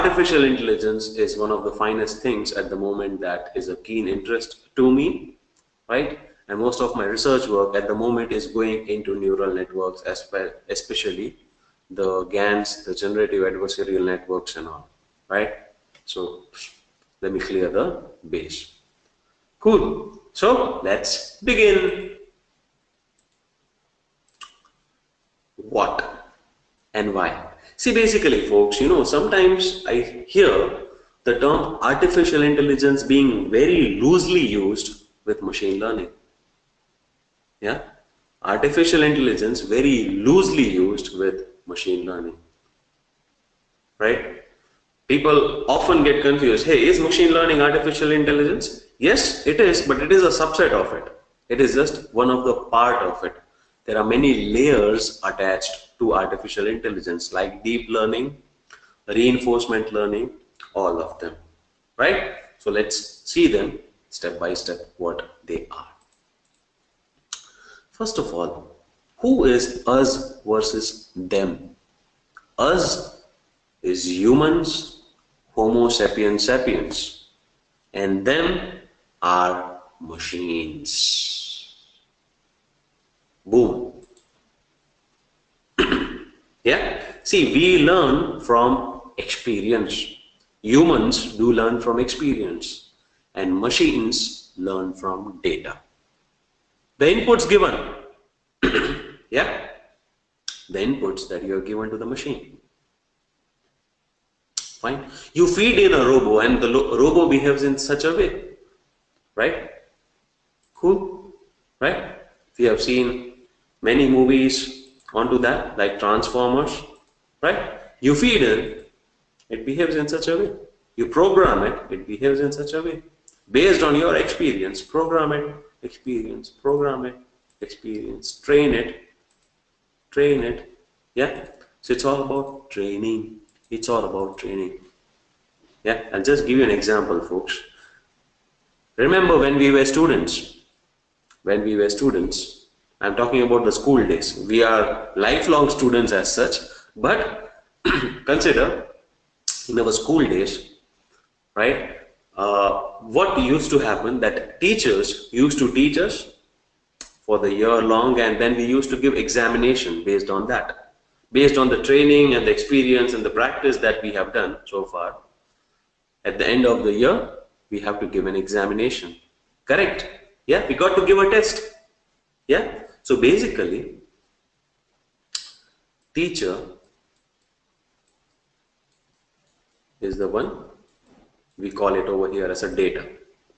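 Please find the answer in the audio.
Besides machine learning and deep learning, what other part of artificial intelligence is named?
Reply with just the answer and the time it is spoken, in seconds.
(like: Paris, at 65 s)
reinforcement learning, at 59 s.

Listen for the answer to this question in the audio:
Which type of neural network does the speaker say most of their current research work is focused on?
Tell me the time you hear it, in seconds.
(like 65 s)
12 s.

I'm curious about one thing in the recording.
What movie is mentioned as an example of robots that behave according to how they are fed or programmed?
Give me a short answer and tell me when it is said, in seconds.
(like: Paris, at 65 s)
Transformers, at 115 s.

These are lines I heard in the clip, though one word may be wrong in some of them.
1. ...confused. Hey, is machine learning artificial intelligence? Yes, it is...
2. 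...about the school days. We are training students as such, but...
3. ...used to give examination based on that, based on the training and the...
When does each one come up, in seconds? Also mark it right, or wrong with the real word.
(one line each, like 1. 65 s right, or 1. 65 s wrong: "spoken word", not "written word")
1. 46 s right
2. 143 s wrong: "lifelong", not "training"
3. 158 s right.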